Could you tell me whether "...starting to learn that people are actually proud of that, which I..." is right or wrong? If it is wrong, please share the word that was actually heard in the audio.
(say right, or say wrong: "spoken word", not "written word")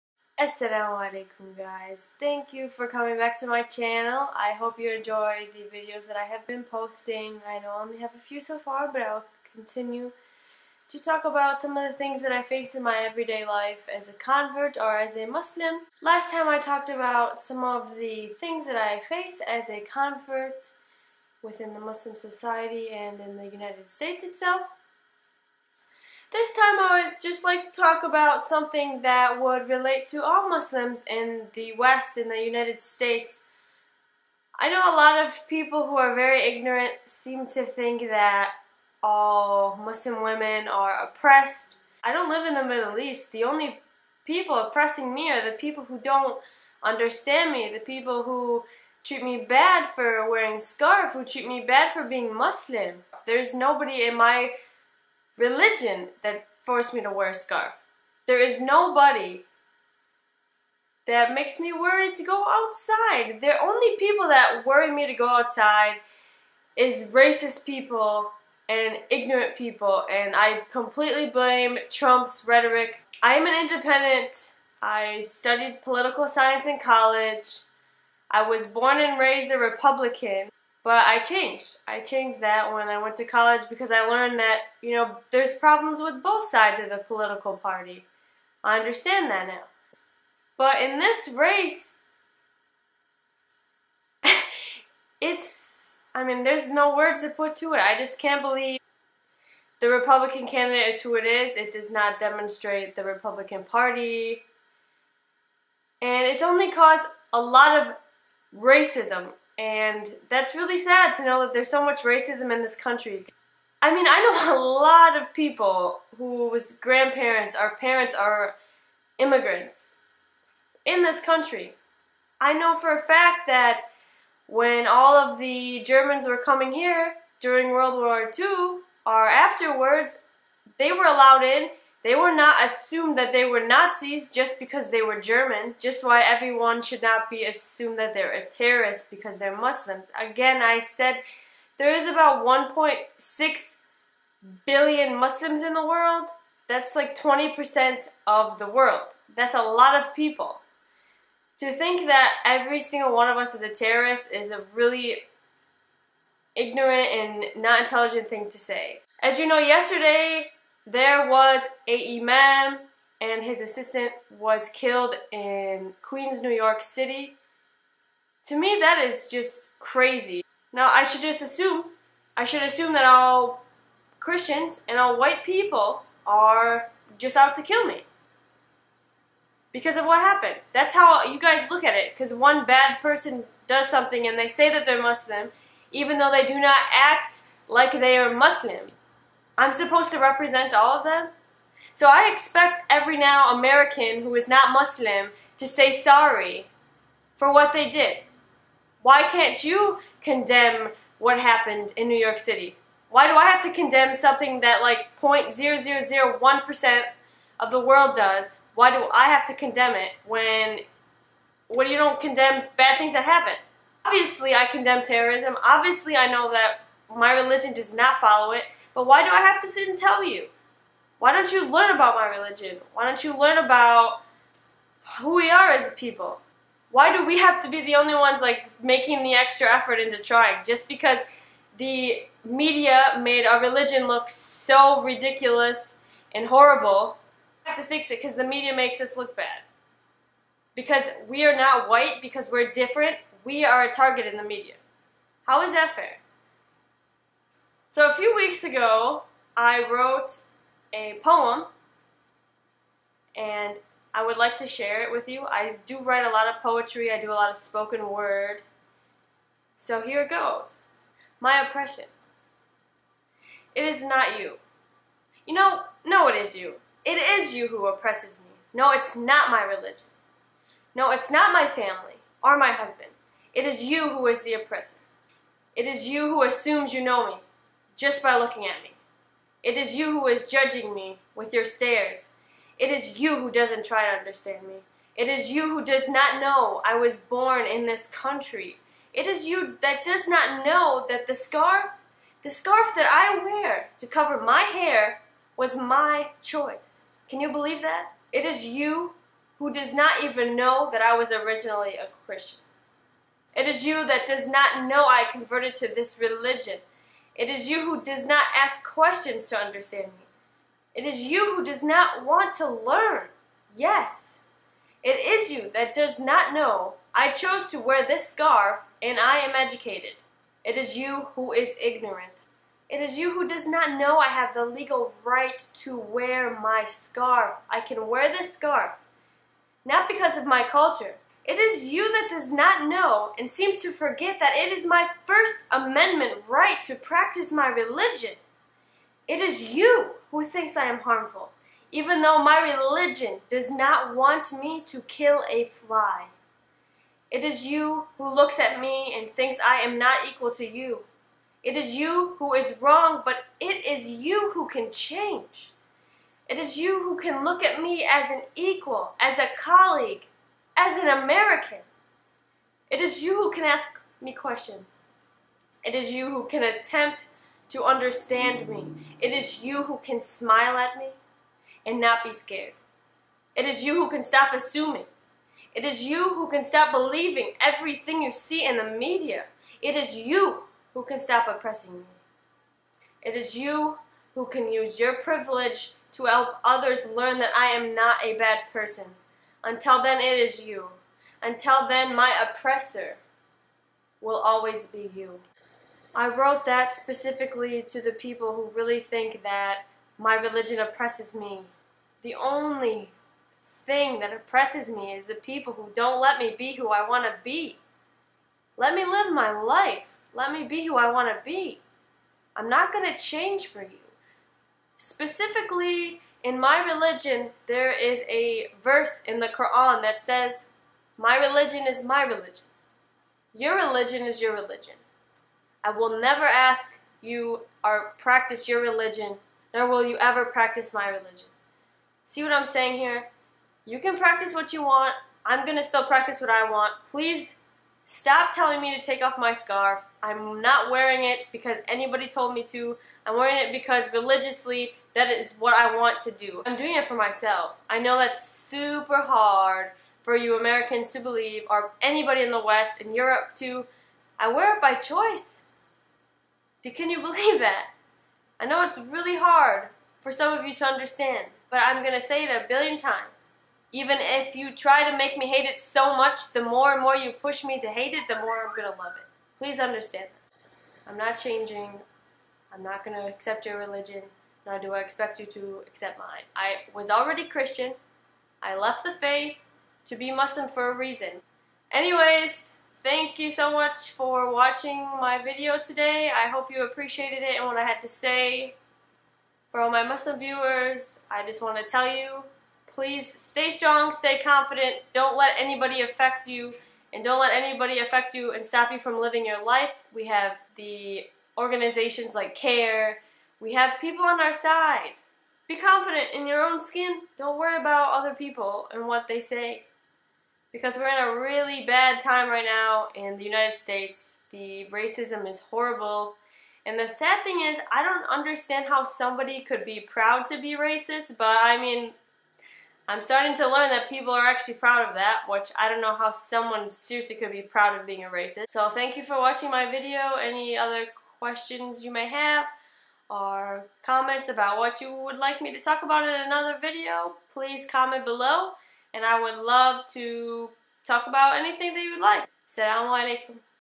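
right.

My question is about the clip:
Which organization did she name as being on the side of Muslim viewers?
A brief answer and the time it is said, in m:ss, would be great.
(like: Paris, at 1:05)
CAIR, at 8:22.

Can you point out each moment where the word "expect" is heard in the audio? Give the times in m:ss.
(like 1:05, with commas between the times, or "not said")
3:12, 7:54.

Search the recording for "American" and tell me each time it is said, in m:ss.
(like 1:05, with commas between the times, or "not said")
3:13, 6:01, 7:30.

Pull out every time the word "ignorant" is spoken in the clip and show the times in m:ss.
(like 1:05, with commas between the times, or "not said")
0:36, 1:09, 2:36, 5:21.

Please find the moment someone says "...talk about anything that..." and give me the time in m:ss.
9:01.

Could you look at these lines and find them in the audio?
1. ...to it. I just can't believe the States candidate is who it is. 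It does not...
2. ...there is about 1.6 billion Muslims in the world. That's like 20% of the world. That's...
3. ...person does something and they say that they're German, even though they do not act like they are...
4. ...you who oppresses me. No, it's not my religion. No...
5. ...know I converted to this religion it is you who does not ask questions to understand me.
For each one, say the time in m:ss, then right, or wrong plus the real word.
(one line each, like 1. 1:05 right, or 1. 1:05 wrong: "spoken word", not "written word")
1. 1:37 wrong: "Republican", not "States"
2. 2:21 right
3. 3:03 wrong: "Muslim", not "German"
4. 4:27 right
5. 5:04 right.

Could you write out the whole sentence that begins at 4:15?
I do write a lot of poetry, I do a lot of spoken word.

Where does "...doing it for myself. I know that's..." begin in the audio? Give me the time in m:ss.
7:26.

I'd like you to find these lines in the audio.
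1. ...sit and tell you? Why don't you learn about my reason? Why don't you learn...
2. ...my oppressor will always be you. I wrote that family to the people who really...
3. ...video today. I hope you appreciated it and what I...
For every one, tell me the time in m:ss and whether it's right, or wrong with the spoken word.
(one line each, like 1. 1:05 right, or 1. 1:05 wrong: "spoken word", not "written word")
1. 3:39 wrong: "religion", not "reason"
2. 6:32 wrong: "specifically", not "family"
3. 8:05 right.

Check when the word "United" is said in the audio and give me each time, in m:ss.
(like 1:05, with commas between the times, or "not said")
0:23, 0:32, 8:33.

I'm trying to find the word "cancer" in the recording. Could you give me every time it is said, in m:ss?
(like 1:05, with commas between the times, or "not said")
not said.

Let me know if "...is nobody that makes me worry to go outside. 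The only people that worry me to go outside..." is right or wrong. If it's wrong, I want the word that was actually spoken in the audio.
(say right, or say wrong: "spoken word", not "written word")
right.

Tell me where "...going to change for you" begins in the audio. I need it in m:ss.
6:52.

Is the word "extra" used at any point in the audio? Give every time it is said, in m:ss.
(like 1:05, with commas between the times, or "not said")
3:49.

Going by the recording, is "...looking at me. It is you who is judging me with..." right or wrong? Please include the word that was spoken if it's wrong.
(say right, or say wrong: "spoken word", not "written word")
right.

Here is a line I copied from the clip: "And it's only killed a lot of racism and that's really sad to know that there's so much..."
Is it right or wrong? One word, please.
wrong.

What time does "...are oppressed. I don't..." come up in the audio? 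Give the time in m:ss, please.
0:40.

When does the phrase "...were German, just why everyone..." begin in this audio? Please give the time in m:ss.
2:15.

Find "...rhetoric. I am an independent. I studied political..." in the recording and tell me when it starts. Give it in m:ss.
1:12.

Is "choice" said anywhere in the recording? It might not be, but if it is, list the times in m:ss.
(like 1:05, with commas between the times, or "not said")
4:56, 7:34.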